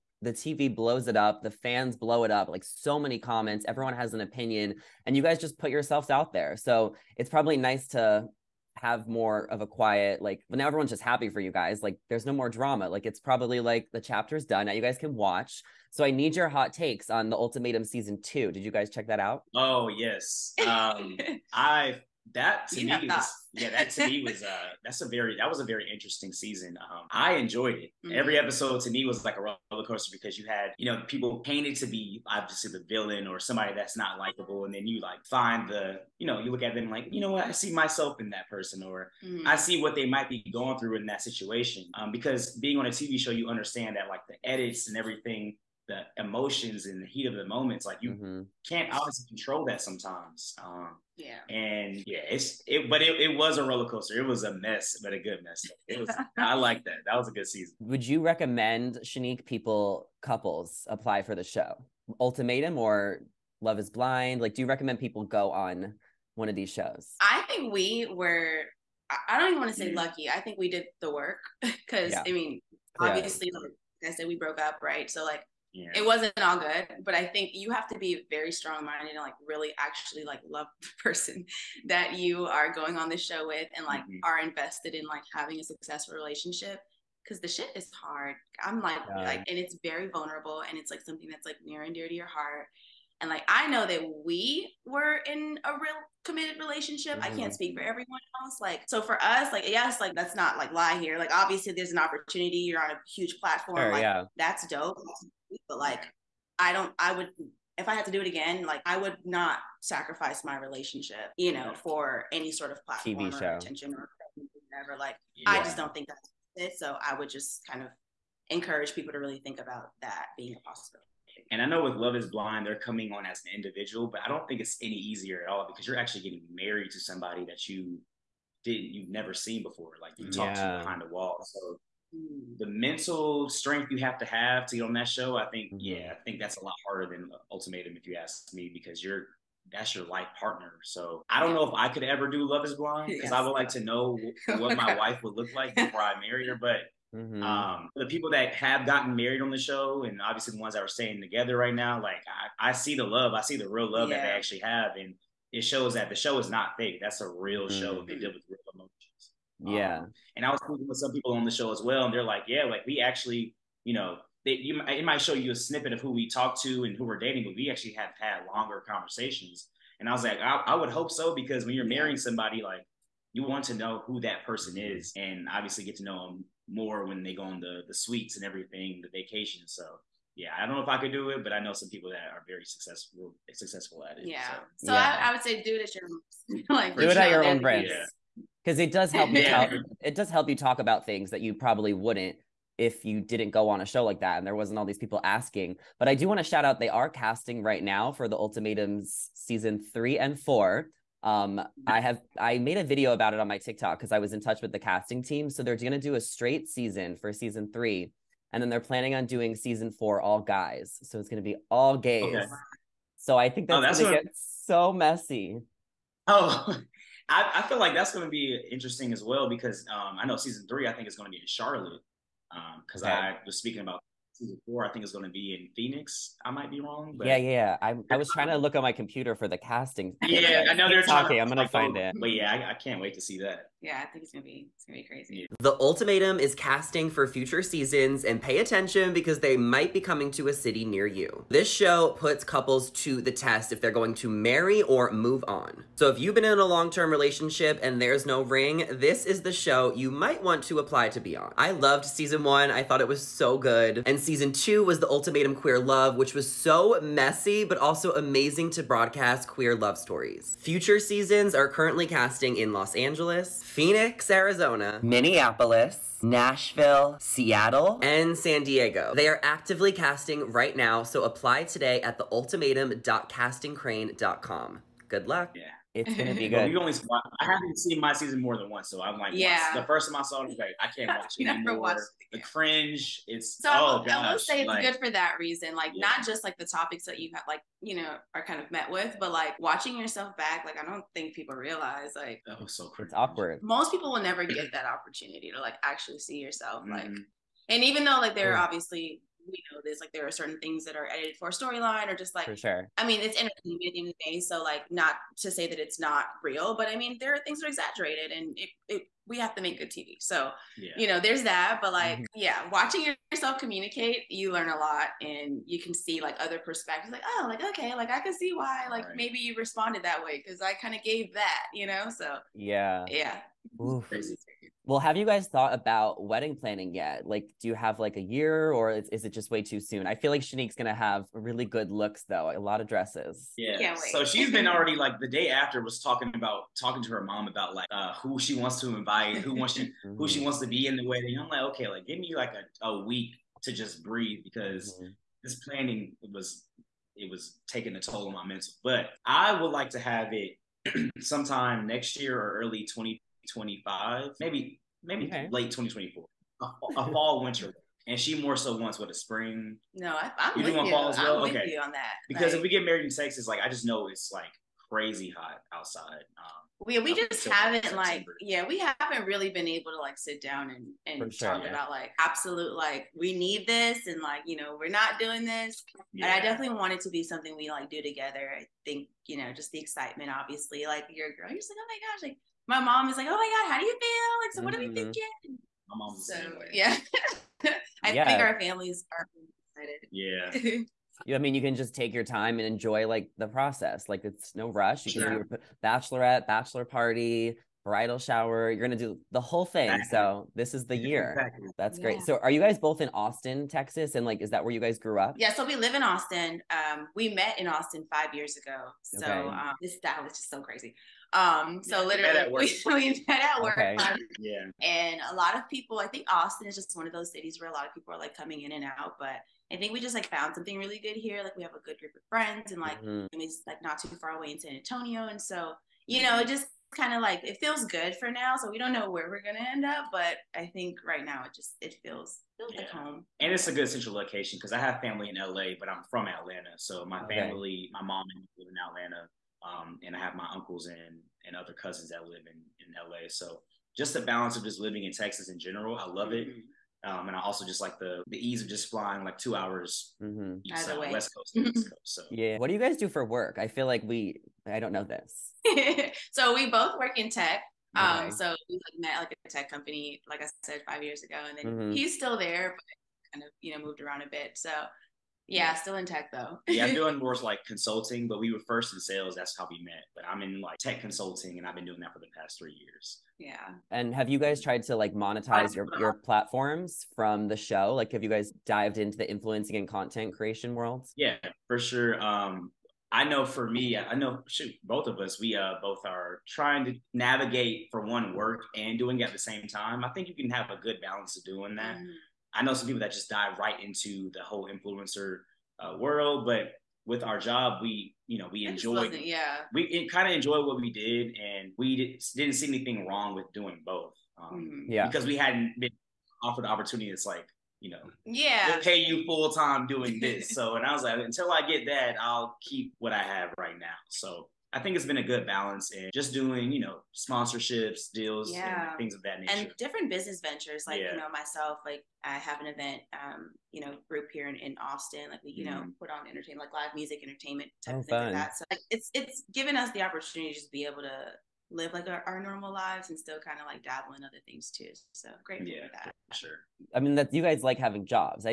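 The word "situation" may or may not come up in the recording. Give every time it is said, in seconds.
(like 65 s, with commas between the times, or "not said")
41 s.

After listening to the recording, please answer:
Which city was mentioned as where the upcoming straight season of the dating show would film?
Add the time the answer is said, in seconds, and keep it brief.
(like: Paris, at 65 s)
Charlotte, at 221 s.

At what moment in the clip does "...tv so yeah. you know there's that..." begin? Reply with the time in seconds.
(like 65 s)
309 s.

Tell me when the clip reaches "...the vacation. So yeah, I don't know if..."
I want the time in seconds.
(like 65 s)
179 s.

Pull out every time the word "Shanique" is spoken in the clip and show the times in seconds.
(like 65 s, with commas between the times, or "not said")
59 s, 330 s.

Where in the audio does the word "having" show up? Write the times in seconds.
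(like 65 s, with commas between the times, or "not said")
85 s, 537 s.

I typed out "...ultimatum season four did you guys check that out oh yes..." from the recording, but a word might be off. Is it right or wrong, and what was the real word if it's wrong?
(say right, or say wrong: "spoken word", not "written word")
wrong: "two", not "four".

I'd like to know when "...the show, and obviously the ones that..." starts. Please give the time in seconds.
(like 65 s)
149 s.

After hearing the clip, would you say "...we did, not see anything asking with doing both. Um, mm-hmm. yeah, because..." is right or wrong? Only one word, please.
wrong.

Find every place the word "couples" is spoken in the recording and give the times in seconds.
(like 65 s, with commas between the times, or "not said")
60 s, 242 s.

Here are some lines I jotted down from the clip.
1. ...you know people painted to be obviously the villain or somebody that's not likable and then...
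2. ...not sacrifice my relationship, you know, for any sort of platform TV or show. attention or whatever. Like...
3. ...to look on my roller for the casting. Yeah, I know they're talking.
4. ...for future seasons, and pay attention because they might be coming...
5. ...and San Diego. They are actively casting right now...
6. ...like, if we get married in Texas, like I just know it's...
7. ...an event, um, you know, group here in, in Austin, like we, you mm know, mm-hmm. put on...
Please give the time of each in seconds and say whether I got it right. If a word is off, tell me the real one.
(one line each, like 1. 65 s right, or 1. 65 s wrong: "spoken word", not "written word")
1. 30 s right
2. 109 s right
3. 228 s wrong: "computer", not "roller"
4. 237 s right
5. 268 s right
6. 362 s right
7. 522 s right.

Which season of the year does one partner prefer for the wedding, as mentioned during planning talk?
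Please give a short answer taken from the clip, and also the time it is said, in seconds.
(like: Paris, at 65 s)
Spring, at 359 s.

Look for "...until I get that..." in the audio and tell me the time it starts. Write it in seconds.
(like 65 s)
511 s.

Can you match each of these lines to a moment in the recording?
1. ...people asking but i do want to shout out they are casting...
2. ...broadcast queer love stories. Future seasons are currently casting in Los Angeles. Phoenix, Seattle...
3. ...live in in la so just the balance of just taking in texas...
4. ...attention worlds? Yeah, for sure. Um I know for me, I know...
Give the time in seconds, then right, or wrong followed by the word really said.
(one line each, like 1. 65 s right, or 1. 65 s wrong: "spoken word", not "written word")
1. 194 s right
2. 258 s wrong: "Arizona", not "Seattle"
3. 442 s wrong: "living", not "taking"
4. 480 s wrong: "creation", not "attention".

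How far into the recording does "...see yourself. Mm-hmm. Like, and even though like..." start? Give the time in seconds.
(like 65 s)
296 s.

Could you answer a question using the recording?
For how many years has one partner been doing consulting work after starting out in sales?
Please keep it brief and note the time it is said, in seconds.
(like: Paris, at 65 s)
3, at 472 s.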